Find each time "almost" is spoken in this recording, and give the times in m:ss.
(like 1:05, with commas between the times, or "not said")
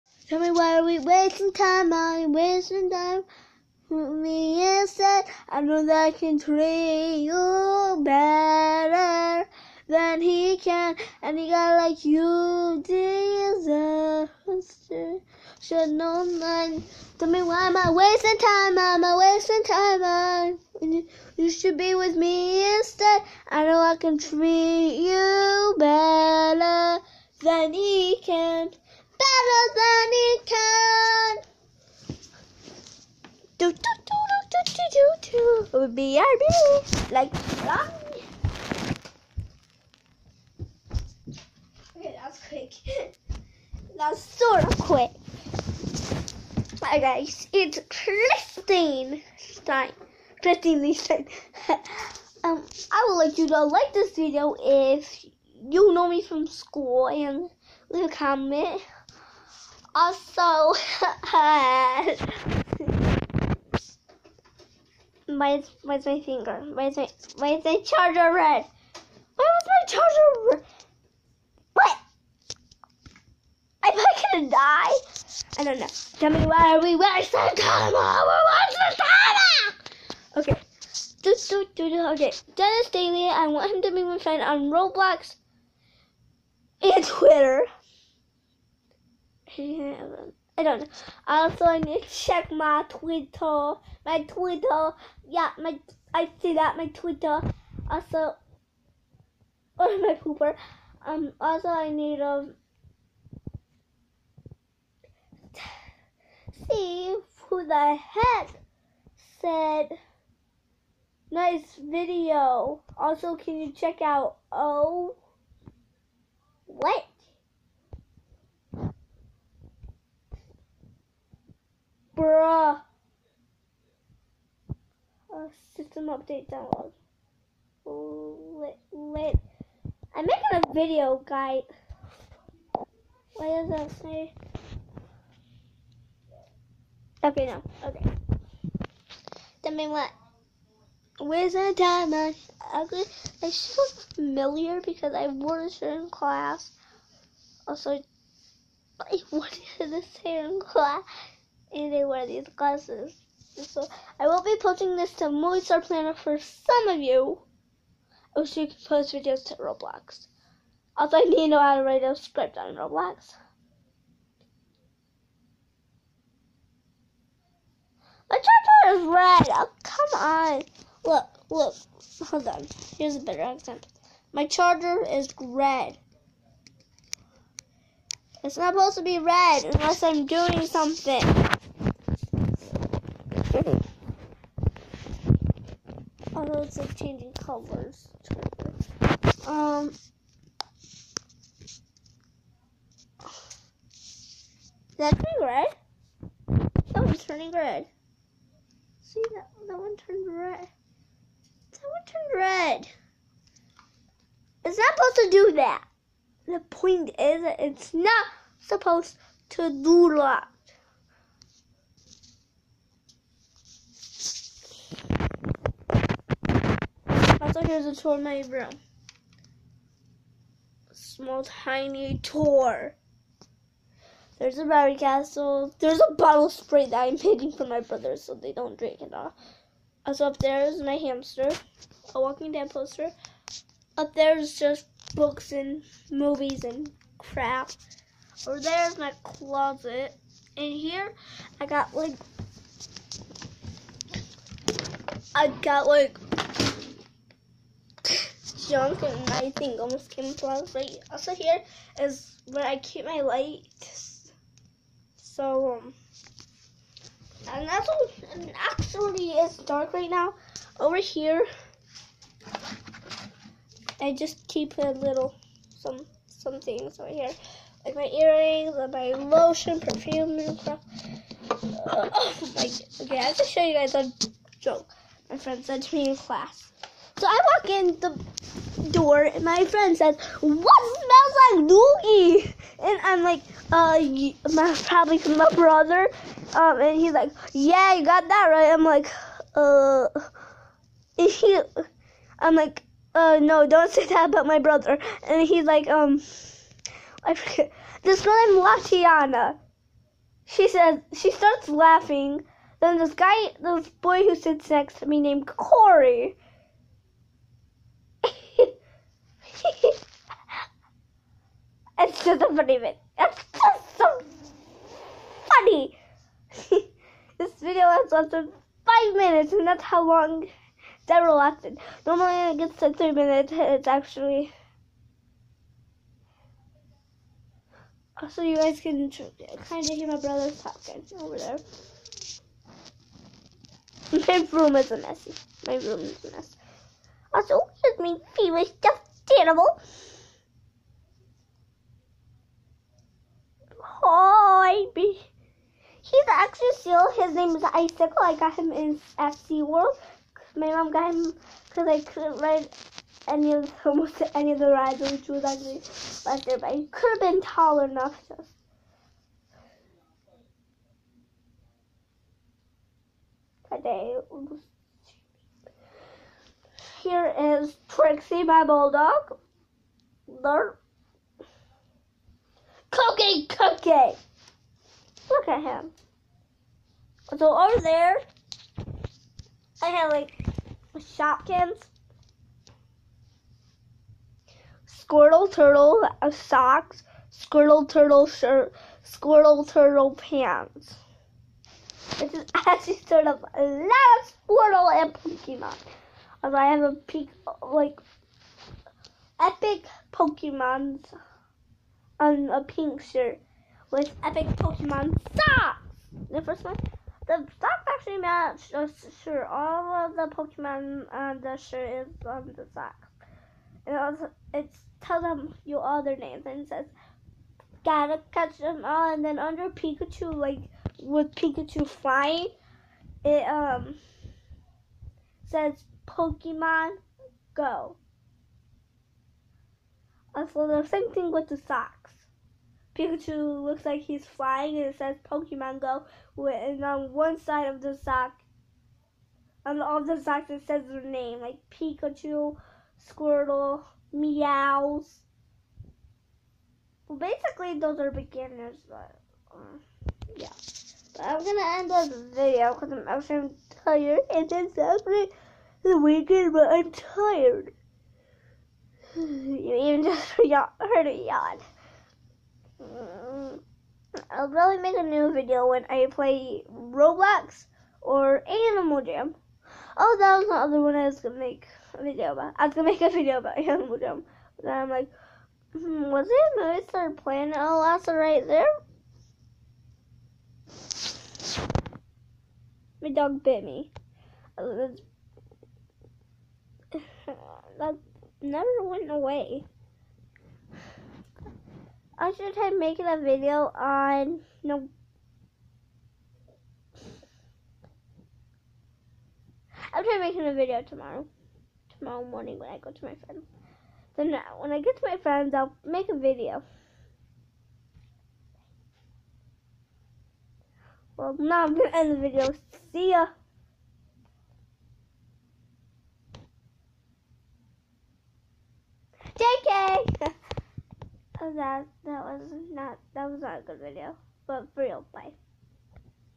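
4:09, 5:53.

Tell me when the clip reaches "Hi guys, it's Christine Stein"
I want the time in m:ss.
0:46.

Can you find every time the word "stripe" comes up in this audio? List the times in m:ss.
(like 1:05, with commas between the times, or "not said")
not said.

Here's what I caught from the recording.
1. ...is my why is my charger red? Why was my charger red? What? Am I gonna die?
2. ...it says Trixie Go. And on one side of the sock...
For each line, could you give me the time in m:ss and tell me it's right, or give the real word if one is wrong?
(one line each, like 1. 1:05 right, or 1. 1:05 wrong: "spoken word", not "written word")
1. 1:06 right
2. 7:14 wrong: "Pokemon", not "Trixie".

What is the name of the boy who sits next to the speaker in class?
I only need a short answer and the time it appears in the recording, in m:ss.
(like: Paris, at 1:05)
Corey, at 5:05.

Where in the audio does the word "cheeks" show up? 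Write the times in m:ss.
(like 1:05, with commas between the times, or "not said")
not said.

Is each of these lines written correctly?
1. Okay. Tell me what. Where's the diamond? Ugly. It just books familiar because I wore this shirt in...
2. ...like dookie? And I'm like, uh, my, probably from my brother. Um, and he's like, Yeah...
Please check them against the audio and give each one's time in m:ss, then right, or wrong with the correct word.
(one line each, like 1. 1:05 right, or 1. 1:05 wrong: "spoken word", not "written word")
1. 2:17 wrong: "looks", not "books"
2. 4:41 right.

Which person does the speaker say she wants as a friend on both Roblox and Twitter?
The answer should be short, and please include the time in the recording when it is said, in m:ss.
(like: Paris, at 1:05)
Dennis Daly, at 1:22.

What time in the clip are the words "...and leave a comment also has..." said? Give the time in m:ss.
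0:57.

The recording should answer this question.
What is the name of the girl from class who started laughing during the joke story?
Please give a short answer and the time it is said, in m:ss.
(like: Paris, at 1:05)
Latiana, at 4:58.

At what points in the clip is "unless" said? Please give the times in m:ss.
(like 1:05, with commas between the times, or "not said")
2:59.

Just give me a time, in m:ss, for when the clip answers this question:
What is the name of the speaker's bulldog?
6:07.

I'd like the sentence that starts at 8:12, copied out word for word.
I should have making a video on no.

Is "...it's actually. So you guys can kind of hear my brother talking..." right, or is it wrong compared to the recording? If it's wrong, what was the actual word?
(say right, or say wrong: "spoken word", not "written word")
right.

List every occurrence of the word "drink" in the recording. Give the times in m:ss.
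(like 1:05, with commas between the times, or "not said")
3:48.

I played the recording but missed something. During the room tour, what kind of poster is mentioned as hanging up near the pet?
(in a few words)
Walking Dead.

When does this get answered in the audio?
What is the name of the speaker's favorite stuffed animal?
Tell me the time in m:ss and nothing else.
5:47.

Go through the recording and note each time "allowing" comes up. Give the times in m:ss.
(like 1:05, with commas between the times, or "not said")
not said.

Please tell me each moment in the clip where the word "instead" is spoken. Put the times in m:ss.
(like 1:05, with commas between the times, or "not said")
0:04, 0:22.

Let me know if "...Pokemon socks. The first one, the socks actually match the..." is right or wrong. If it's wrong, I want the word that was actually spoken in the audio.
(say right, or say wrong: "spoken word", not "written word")
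right.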